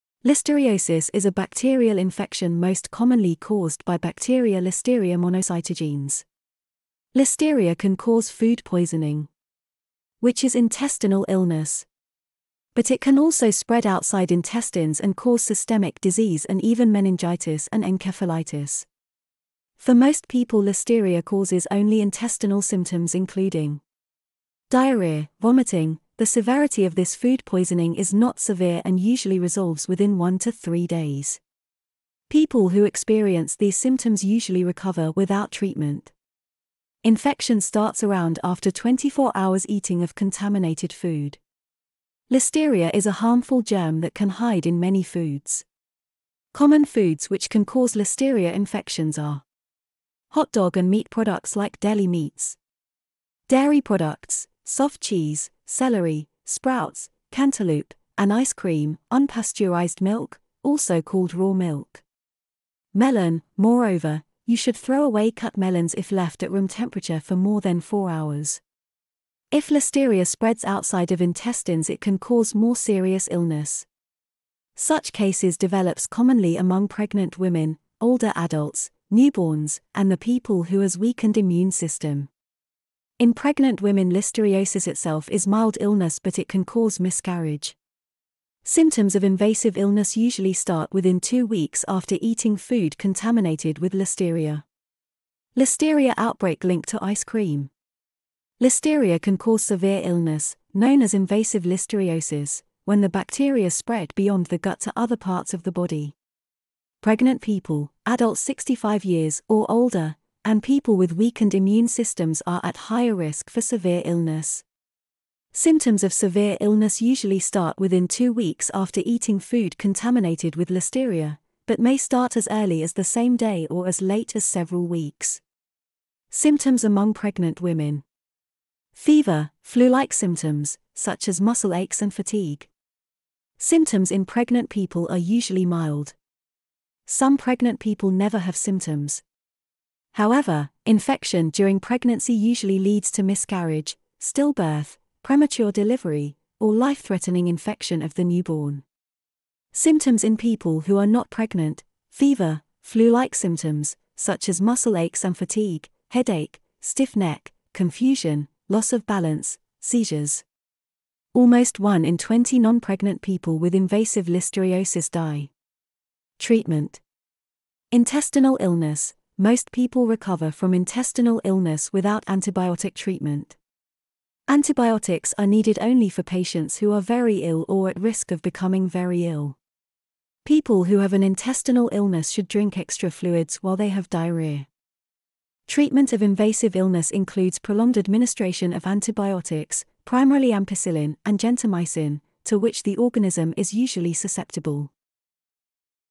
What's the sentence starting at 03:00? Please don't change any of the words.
People who have an intestinal illness should drink extra fluids while they have diarrhea.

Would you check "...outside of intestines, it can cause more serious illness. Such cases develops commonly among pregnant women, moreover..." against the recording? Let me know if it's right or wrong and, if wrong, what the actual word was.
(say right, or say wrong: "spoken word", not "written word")
wrong: "older", not "moreover".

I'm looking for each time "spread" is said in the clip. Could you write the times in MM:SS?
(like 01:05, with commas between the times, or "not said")
00:13, 01:10, 01:43.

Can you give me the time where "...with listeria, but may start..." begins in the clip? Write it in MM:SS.
02:00.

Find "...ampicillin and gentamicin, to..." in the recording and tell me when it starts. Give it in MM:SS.
03:10.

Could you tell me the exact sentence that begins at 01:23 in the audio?
In pregnant women, listeriosis itself is mild illness, but it can cause miscarriage.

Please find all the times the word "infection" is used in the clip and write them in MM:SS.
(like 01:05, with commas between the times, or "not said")
00:01, 00:37, 00:48, 02:20, 02:27.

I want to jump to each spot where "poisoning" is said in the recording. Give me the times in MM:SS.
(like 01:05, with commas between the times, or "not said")
00:08, 00:27.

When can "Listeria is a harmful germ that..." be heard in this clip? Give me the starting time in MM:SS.
00:42.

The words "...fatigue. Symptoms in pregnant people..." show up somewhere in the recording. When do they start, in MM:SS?
02:12.